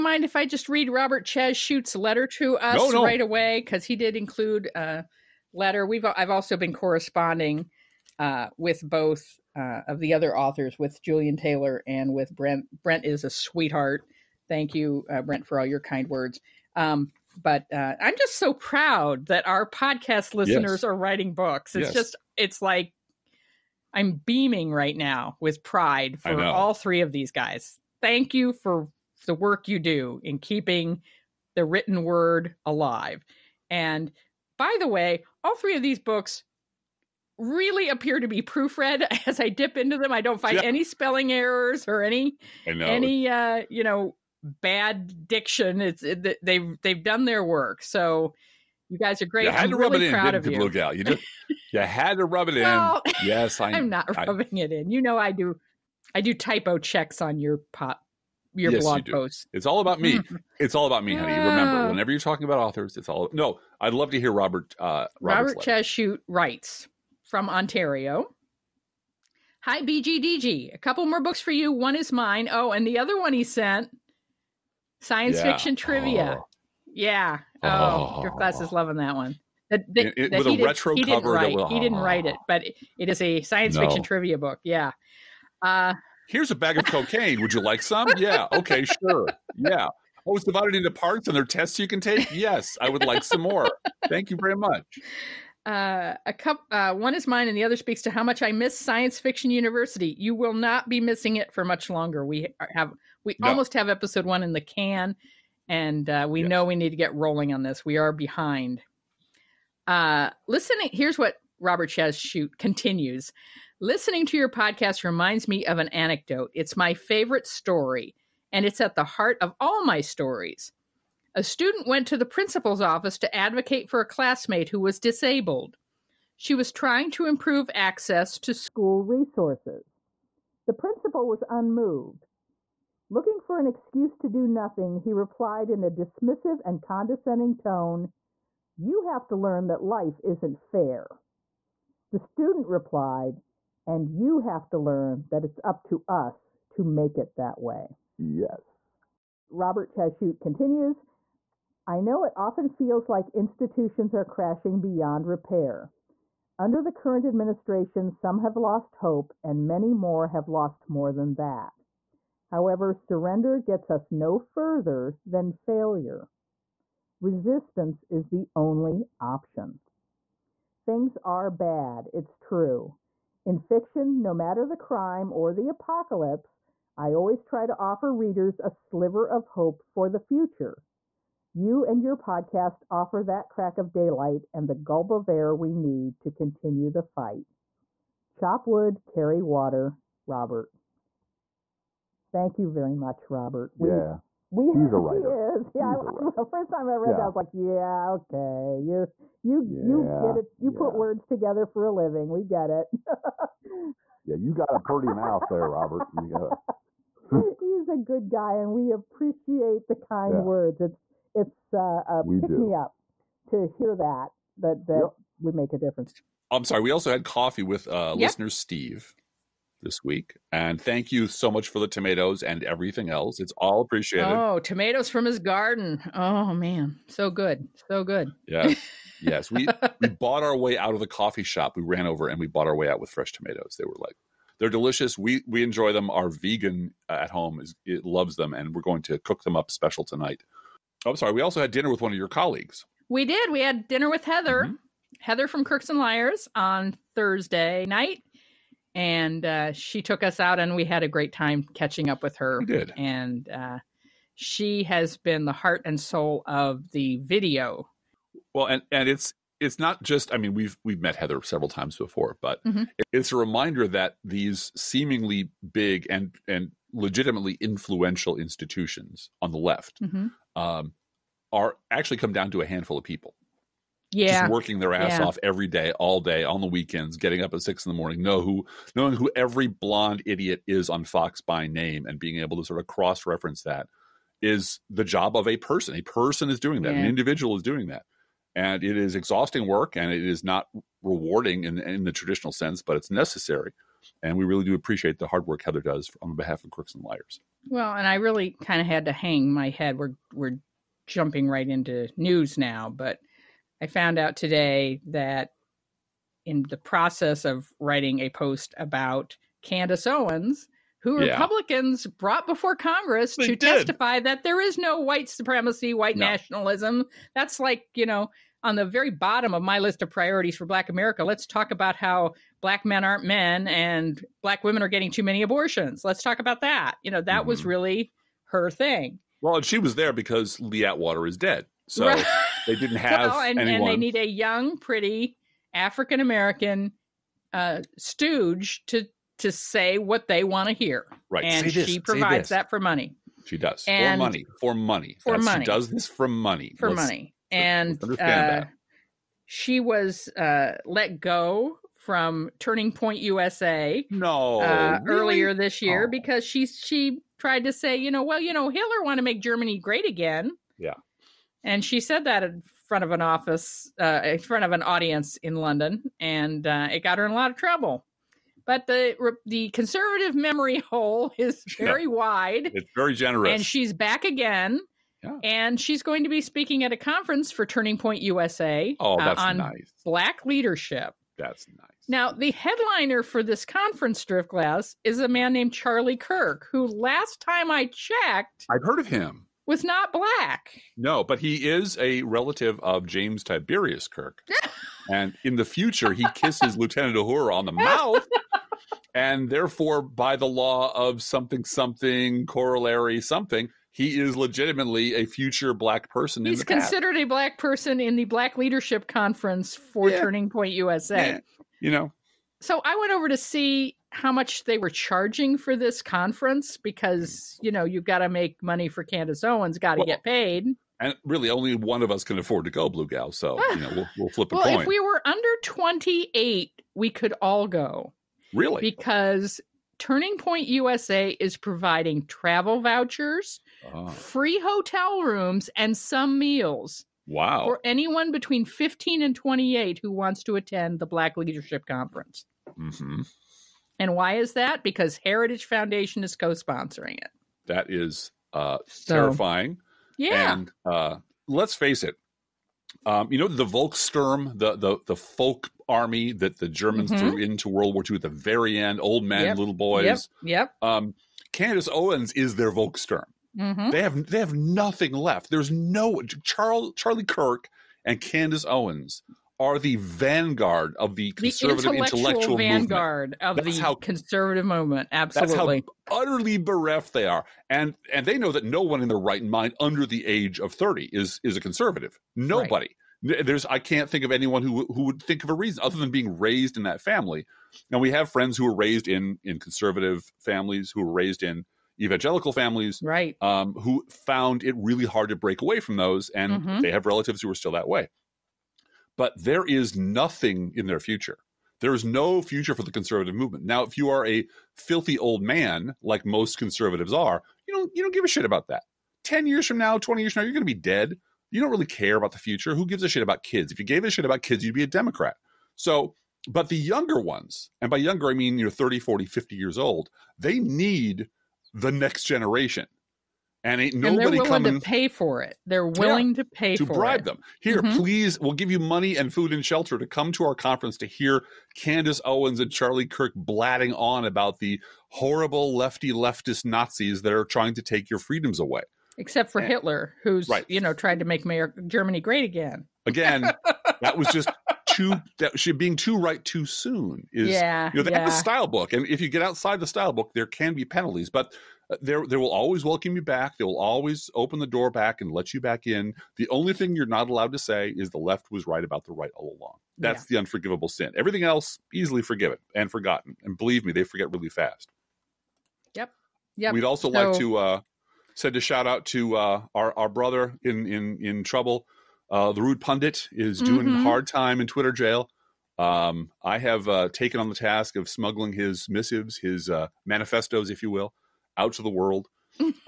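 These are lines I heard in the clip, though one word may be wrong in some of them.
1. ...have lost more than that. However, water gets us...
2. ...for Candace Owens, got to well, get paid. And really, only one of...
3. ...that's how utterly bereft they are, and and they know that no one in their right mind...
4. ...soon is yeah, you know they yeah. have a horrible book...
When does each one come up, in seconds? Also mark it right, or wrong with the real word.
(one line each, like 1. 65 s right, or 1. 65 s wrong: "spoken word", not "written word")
1. 160 s wrong: "surrender", not "water"
2. 418 s right
3. 475 s right
4. 546 s wrong: "style", not "horrible".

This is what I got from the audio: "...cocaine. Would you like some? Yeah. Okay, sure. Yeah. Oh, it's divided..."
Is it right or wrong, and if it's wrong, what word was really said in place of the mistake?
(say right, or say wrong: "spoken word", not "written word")
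right.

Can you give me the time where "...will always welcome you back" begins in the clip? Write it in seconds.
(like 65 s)
552 s.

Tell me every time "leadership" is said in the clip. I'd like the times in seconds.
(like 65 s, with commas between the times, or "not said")
380 s, 408 s, 441 s.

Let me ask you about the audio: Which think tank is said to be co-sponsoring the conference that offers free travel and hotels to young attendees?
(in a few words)
Heritage Foundation.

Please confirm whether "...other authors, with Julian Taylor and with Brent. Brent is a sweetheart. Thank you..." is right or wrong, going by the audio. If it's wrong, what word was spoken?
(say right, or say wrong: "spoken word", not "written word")
right.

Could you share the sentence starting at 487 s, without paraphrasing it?
And we have friends who were raised in in conservative families, who were raised in evangelical families, right?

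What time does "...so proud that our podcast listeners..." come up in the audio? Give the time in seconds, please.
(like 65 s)
18 s.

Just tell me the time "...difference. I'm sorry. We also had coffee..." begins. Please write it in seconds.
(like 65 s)
215 s.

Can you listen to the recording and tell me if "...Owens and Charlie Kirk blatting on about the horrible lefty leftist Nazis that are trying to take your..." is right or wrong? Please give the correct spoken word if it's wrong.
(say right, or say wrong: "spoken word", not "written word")
right.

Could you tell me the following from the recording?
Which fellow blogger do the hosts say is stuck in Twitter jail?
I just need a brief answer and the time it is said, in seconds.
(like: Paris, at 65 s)
The Rude Pundit, at 572 s.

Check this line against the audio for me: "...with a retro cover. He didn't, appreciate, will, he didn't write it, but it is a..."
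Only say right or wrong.
wrong.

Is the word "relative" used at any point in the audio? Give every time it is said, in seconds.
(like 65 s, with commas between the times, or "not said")
392 s, 497 s.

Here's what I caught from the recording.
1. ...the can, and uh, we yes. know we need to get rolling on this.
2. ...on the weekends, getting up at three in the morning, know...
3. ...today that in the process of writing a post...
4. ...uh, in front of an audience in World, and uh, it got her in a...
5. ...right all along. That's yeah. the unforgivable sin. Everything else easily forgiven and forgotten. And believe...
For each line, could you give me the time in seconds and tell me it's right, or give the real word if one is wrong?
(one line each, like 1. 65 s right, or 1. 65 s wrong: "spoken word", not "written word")
1. 104 s right
2. 276 s wrong: "six", not "three"
3. 304 s right
4. 363 s wrong: "London", not "World"
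5. 559 s right.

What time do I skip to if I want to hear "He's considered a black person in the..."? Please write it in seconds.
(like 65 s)
406 s.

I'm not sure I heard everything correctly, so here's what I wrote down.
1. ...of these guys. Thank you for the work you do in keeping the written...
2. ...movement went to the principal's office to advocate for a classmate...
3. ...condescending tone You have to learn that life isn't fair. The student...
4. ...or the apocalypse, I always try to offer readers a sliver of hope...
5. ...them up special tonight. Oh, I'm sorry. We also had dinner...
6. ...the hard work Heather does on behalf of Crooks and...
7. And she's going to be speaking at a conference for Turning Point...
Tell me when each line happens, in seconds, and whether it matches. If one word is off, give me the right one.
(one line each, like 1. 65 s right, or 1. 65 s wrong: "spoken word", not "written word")
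1. 27 s right
2. 121 s wrong: "student", not "movement"
3. 136 s right
4. 175 s right
5. 239 s right
6. 295 s right
7. 375 s right.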